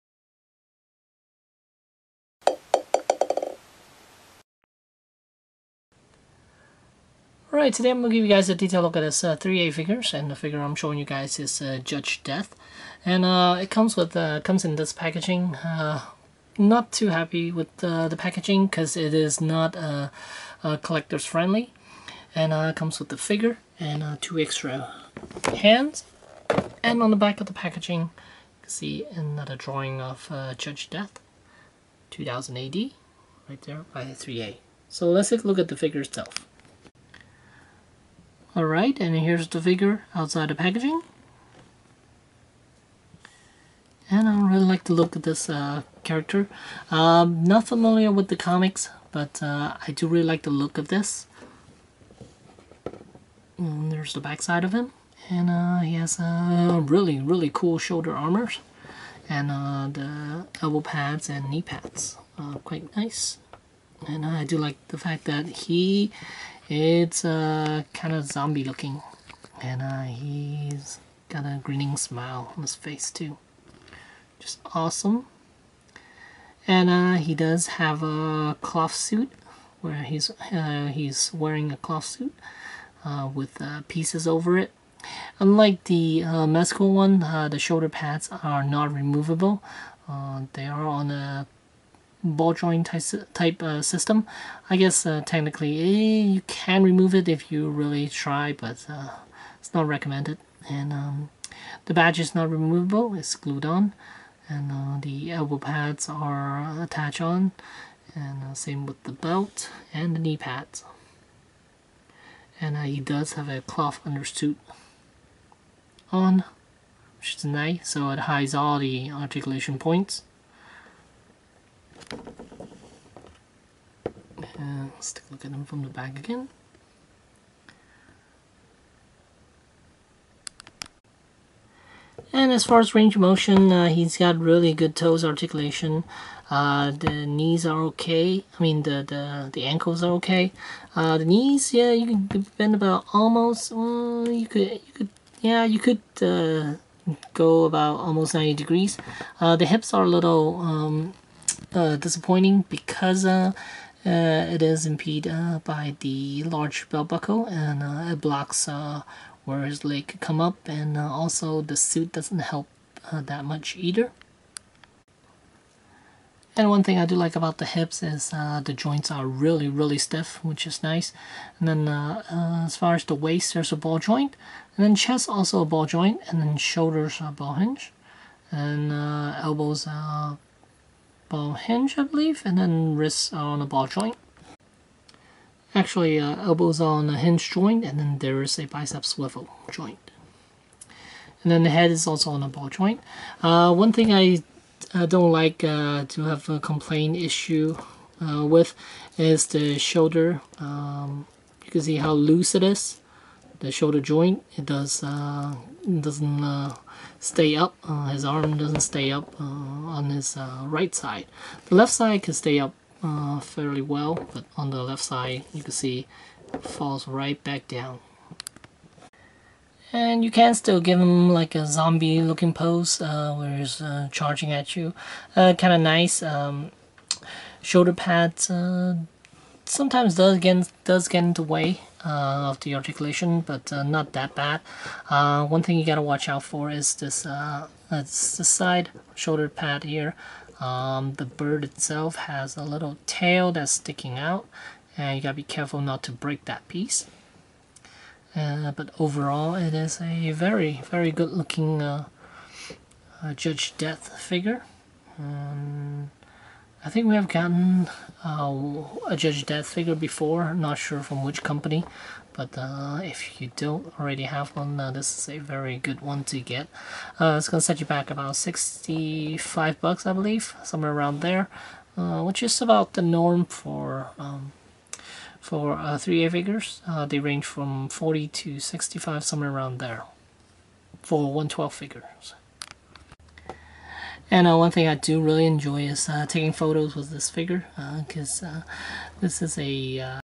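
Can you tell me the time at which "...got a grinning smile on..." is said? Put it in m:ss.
1:11.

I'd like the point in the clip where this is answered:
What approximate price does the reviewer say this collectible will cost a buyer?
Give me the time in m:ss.
4:28.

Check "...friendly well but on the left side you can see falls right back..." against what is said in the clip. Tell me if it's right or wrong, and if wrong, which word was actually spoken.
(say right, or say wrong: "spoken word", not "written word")
wrong: "fairly", not "friendly".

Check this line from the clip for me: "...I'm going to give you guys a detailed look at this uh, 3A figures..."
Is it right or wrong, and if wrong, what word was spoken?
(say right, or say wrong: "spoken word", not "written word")
right.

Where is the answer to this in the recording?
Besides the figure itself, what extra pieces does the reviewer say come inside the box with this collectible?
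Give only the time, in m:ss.
0:24.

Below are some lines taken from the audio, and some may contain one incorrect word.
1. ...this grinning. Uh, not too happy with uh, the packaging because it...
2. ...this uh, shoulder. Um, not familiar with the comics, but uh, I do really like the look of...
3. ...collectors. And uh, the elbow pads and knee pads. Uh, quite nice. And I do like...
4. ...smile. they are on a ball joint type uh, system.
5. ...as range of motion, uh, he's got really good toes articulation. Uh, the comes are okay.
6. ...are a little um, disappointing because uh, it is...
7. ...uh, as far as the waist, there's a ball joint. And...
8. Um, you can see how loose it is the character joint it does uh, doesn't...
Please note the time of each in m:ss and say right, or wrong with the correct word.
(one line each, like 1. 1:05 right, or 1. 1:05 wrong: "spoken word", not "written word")
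1. 0:14 wrong: "packaging", not "grinning"
2. 0:45 wrong: "character", not "shoulder"
3. 0:58 wrong: "armors", not "collectors"
4. 1:28 wrong: "removable", not "smile"
5. 2:12 wrong: "knees", not "comes"
6. 2:29 right
7. 2:52 right
8. 3:20 wrong: "shoulder", not "character".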